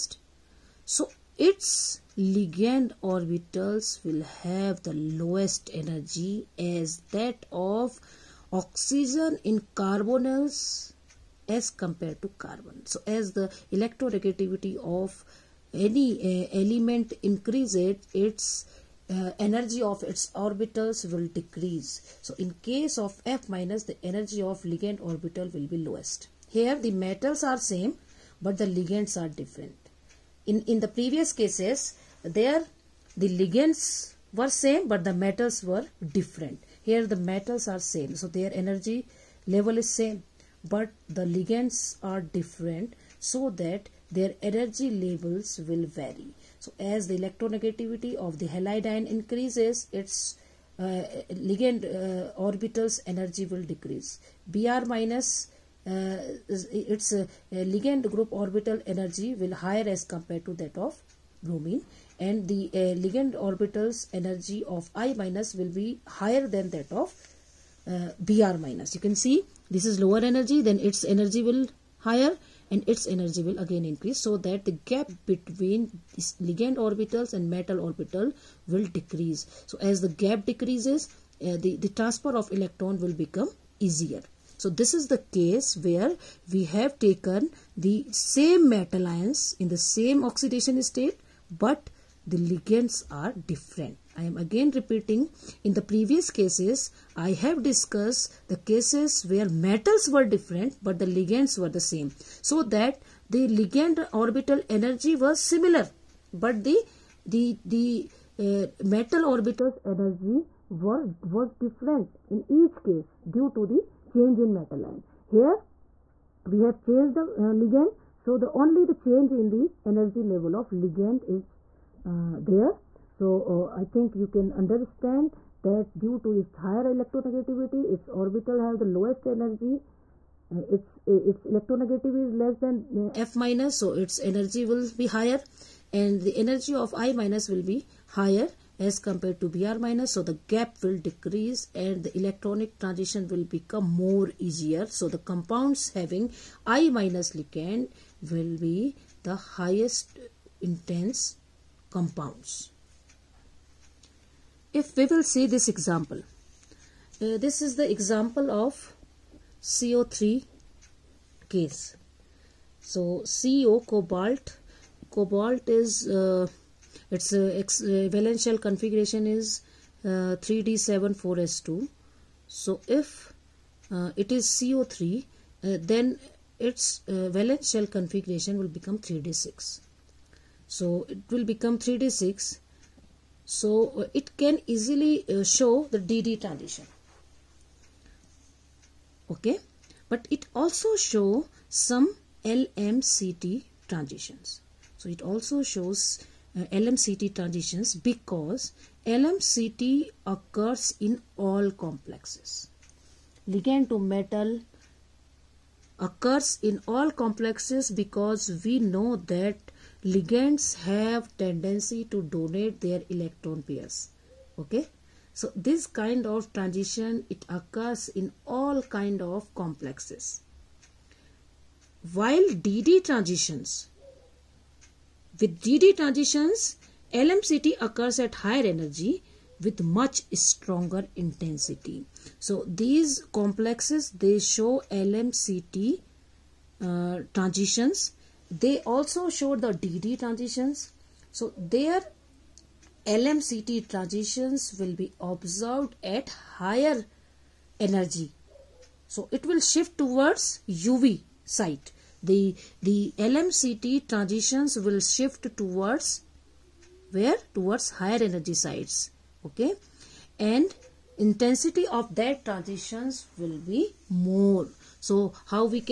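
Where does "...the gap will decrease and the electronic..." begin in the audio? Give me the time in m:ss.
2:20.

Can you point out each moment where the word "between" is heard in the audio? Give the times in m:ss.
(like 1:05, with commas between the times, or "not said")
1:15.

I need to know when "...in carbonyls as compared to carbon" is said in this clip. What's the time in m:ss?
0:09.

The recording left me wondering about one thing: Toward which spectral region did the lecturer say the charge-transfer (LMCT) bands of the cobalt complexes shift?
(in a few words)
UV.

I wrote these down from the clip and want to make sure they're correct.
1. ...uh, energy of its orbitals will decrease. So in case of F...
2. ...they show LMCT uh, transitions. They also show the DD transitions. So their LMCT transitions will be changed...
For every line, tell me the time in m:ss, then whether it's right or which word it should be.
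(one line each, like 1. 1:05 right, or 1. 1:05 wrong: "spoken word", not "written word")
1. 0:19 right
2. 3:54 wrong: "observed", not "changed".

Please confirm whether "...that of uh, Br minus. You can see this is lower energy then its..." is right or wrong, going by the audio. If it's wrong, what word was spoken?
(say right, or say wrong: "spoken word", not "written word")
right.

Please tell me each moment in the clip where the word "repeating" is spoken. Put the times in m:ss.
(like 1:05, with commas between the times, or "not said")
1:34.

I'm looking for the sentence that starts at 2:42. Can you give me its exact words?
So CO cobalt, cobalt is uh, its uh, uh, valence shell configuration is 3D74S2.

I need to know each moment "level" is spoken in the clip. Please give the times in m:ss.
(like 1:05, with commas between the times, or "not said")
0:39, 0:44, 2:00.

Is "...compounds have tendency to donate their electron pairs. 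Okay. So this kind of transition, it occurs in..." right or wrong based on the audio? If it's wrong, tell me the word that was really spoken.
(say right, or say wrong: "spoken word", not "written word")
wrong: "ligands", not "compounds".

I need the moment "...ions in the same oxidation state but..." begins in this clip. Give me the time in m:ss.
1:29.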